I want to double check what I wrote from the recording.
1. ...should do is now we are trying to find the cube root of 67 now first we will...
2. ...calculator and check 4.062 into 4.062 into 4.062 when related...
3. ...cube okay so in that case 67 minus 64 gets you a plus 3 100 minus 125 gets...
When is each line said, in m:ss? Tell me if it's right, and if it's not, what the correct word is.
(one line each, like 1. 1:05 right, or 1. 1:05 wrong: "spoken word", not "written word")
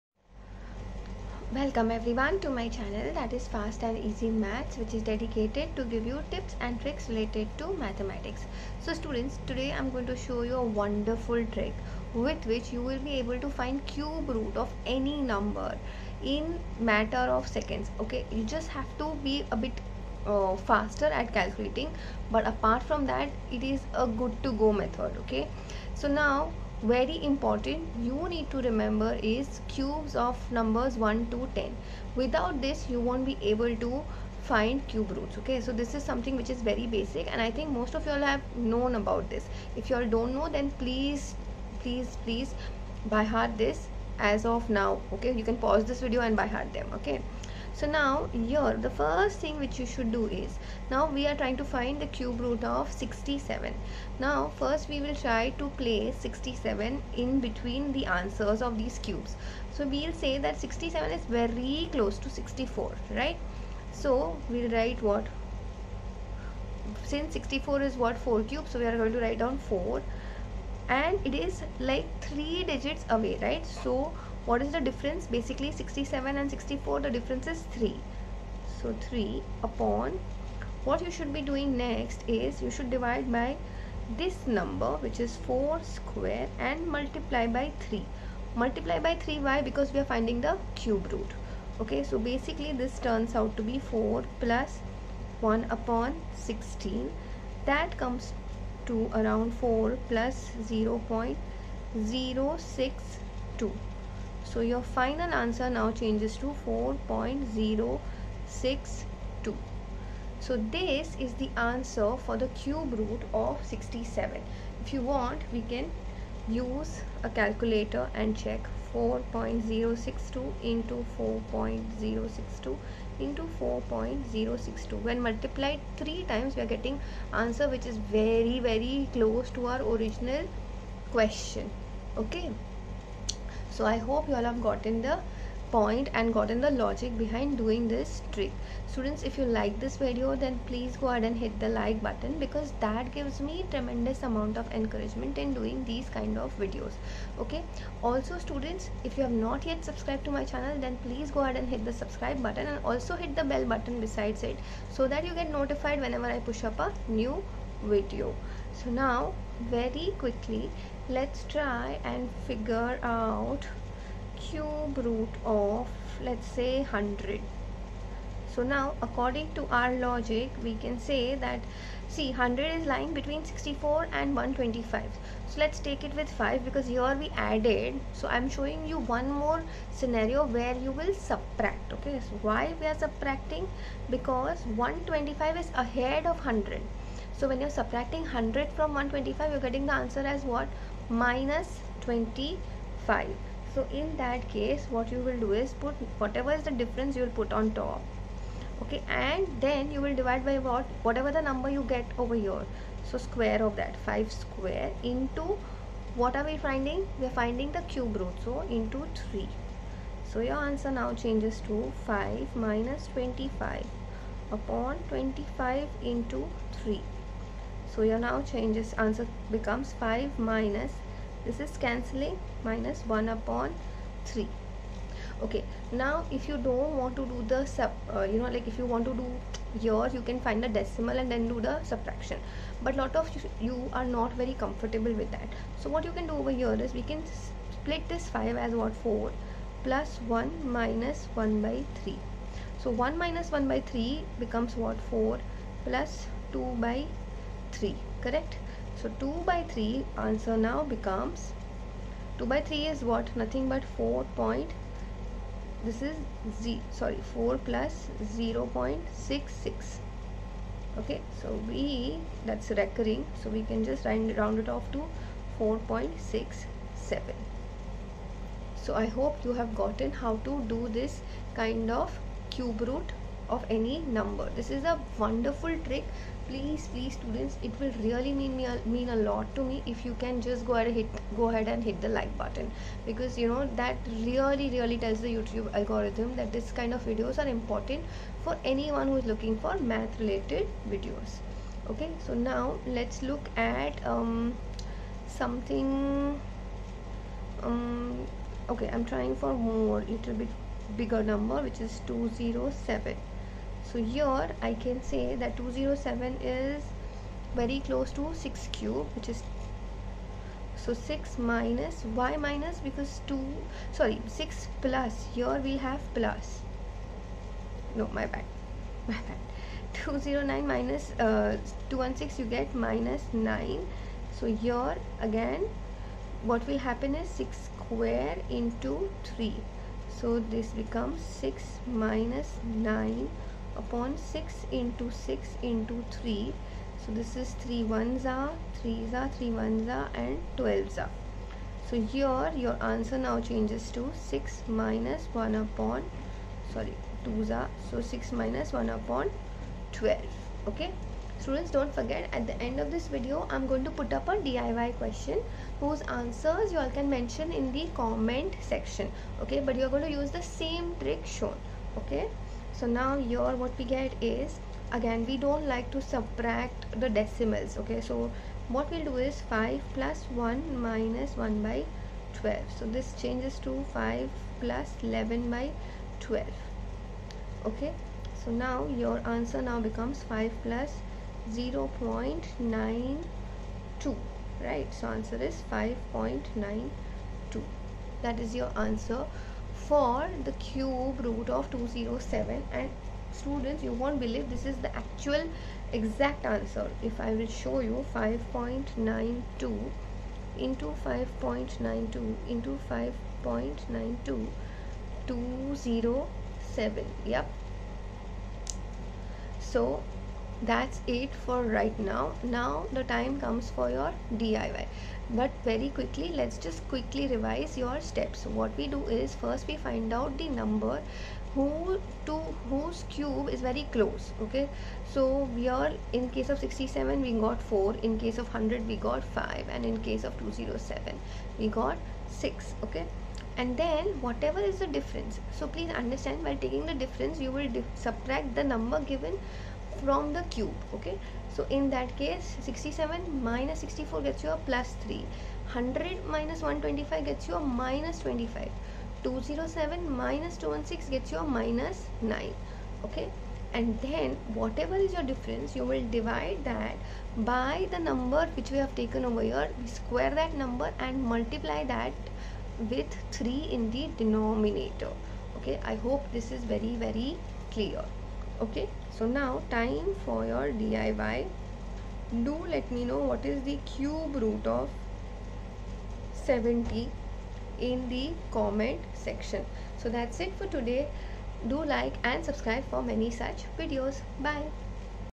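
1. 0:49 right
2. 1:57 wrong: "multiplied", not "related"
3. 7:20 right.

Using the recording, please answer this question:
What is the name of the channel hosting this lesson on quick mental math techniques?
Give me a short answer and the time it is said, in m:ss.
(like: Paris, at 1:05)
Fast and Easy Maths, at 0:03.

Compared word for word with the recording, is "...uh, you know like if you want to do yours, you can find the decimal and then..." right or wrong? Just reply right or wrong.
right.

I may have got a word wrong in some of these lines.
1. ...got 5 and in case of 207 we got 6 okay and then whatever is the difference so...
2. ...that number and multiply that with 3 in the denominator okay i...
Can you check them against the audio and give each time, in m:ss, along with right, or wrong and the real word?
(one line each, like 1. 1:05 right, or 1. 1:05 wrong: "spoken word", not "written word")
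1. 7:08 right
2. 7:40 right.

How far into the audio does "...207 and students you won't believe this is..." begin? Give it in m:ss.
6:31.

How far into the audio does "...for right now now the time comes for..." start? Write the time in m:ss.
6:51.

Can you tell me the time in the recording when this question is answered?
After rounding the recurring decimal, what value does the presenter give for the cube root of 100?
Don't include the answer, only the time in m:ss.
4:25.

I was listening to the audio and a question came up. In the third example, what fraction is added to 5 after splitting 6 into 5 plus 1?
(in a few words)
11/12.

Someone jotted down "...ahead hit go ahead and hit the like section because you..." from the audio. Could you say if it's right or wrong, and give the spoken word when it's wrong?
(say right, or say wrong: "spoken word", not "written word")
wrong: "button", not "section".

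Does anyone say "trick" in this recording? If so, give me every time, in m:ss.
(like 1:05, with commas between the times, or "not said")
0:06, 0:11, 2:18, 4:35, 6:01.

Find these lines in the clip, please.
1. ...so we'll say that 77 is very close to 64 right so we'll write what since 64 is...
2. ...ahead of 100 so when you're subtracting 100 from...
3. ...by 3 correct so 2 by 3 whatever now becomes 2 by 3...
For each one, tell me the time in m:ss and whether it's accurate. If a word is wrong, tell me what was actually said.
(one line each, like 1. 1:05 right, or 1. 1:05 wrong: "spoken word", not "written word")
1. 0:59 wrong: "67", not "77"
2. 3:05 right
3. 4:06 wrong: "answer", not "whatever".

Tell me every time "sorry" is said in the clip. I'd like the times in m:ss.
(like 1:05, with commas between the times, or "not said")
4:16, 5:13, 5:46.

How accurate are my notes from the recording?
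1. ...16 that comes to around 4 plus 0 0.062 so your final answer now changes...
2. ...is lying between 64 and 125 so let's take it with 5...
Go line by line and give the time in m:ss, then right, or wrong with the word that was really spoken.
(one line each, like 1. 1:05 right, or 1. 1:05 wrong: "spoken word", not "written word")
1. 1:36 right
2. 2:52 right.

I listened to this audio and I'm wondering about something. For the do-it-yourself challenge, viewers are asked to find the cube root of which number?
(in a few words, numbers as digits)
70.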